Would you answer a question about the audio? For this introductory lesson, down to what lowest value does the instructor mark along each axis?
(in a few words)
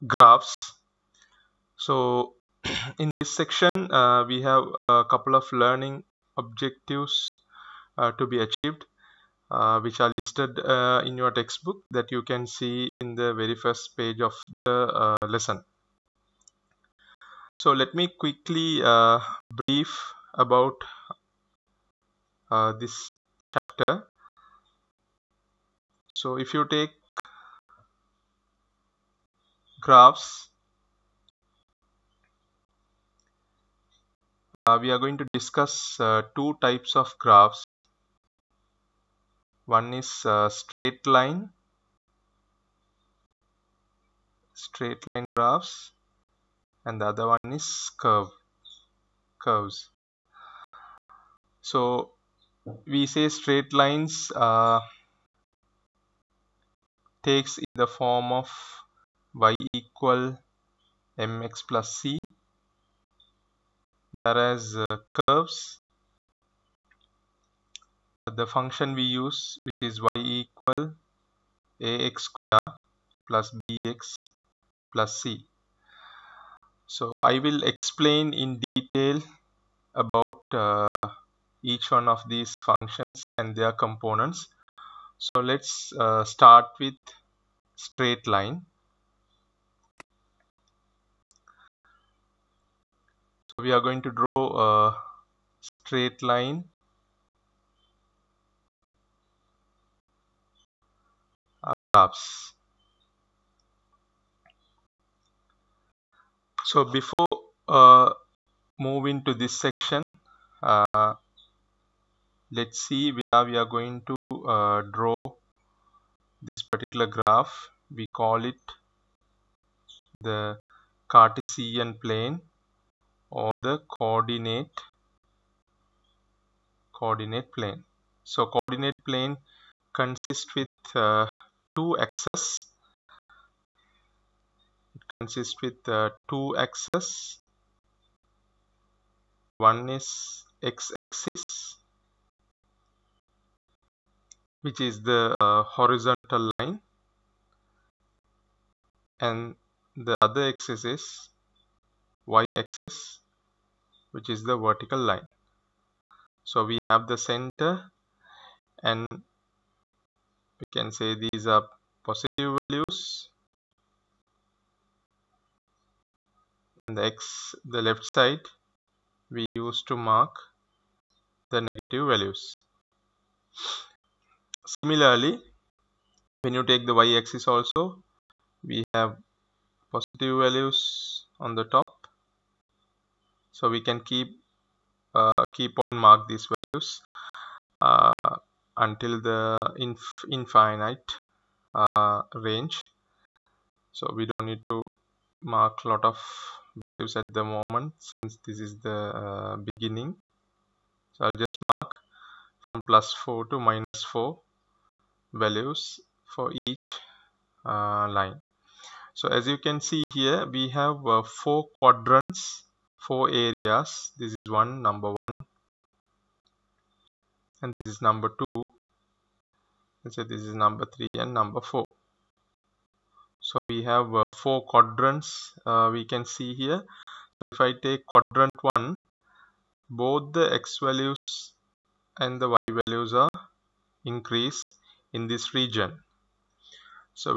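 -4.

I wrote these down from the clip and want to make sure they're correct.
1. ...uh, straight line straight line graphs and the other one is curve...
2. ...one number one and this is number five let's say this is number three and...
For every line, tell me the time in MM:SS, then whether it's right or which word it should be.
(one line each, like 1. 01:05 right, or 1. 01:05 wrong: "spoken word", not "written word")
1. 00:40 right
2. 03:34 wrong: "two", not "five".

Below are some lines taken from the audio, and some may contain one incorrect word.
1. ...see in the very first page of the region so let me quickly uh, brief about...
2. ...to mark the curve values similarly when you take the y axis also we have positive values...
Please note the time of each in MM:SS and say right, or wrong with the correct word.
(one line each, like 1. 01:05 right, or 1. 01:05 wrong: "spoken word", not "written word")
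1. 00:12 wrong: "lesson", not "region"
2. 02:49 wrong: "negative", not "curve".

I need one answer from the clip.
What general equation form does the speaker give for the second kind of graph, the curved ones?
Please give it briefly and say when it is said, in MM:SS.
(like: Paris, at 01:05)
y = ax^2 + bx + c, at 01:10.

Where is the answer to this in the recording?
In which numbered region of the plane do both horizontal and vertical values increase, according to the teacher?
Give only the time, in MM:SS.
03:48.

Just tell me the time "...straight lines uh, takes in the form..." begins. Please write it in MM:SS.
00:53.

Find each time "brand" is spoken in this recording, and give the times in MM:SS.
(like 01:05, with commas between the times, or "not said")
not said.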